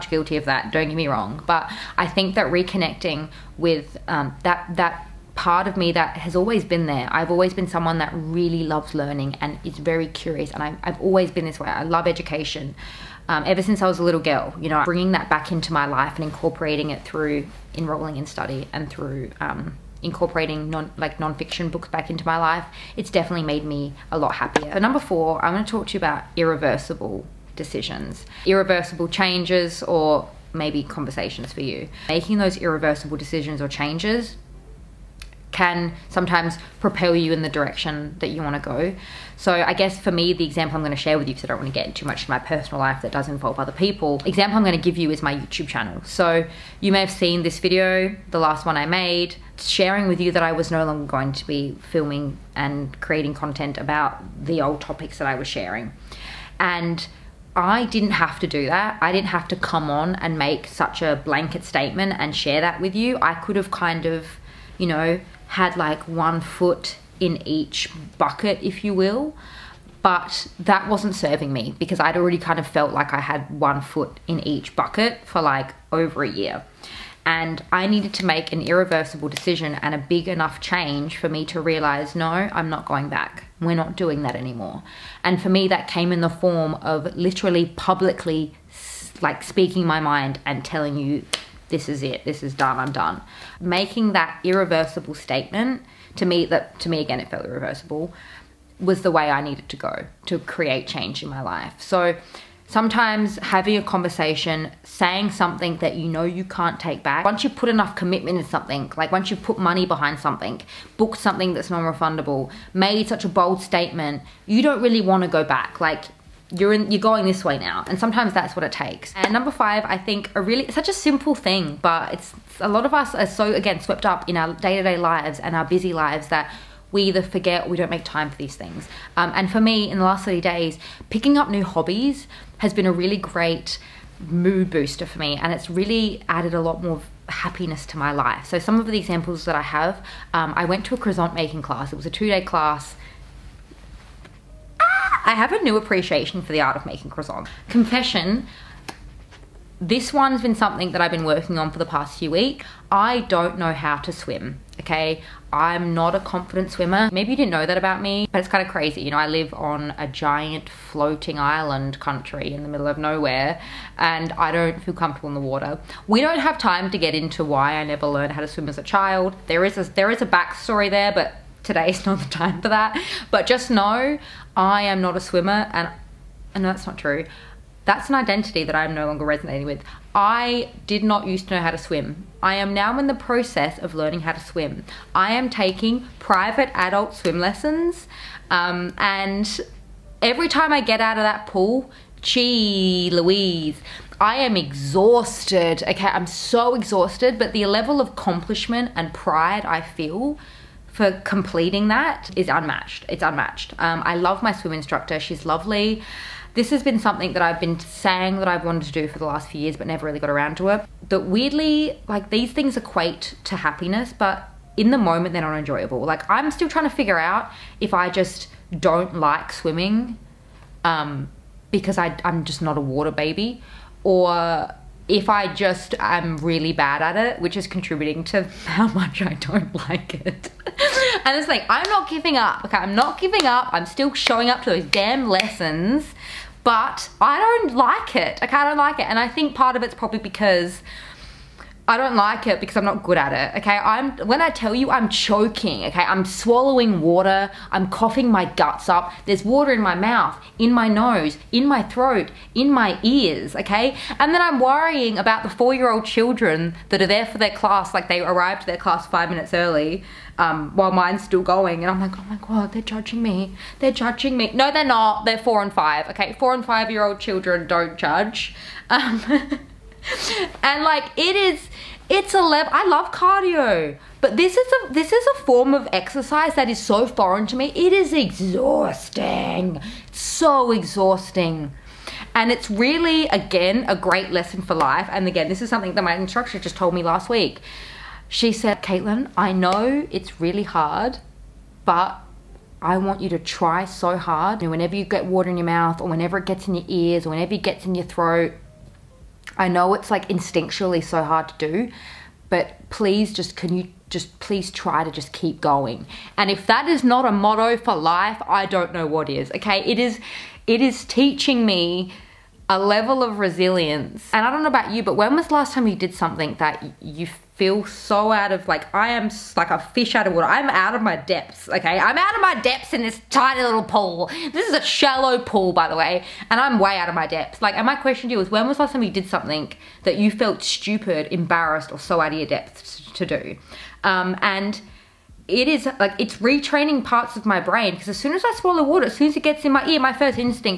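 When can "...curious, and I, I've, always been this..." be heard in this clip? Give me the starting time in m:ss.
0:10.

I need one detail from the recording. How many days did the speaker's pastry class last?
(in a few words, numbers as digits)
2.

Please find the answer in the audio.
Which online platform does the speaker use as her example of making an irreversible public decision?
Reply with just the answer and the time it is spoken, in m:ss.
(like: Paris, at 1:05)
YouTube, at 0:45.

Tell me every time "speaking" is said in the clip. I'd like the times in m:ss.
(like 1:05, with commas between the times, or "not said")
1:29.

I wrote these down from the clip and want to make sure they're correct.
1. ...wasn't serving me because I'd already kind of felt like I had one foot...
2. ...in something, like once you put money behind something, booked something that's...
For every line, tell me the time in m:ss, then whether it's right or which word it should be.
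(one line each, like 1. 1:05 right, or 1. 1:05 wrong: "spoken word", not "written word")
1. 1:10 right
2. 1:48 right.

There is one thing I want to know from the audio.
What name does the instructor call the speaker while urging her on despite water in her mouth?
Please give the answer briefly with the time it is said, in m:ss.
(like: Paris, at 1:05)
Caitlin, at 4:48.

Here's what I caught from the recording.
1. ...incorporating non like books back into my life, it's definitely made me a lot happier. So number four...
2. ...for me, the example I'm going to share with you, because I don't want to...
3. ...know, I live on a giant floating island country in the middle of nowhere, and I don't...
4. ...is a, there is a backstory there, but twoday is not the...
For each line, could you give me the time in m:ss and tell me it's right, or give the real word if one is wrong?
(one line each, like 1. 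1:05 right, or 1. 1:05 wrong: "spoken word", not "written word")
1. 0:20 right
2. 0:39 right
3. 2:39 right
4. 2:49 wrong: "today", not "twoday".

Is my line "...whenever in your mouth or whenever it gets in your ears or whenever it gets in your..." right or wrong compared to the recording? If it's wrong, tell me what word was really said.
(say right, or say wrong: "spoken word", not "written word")
wrong: "water", not "whenever".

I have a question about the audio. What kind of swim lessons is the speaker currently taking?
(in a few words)
Private adult swim lessons.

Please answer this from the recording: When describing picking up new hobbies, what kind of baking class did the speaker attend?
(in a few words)
Croissant making.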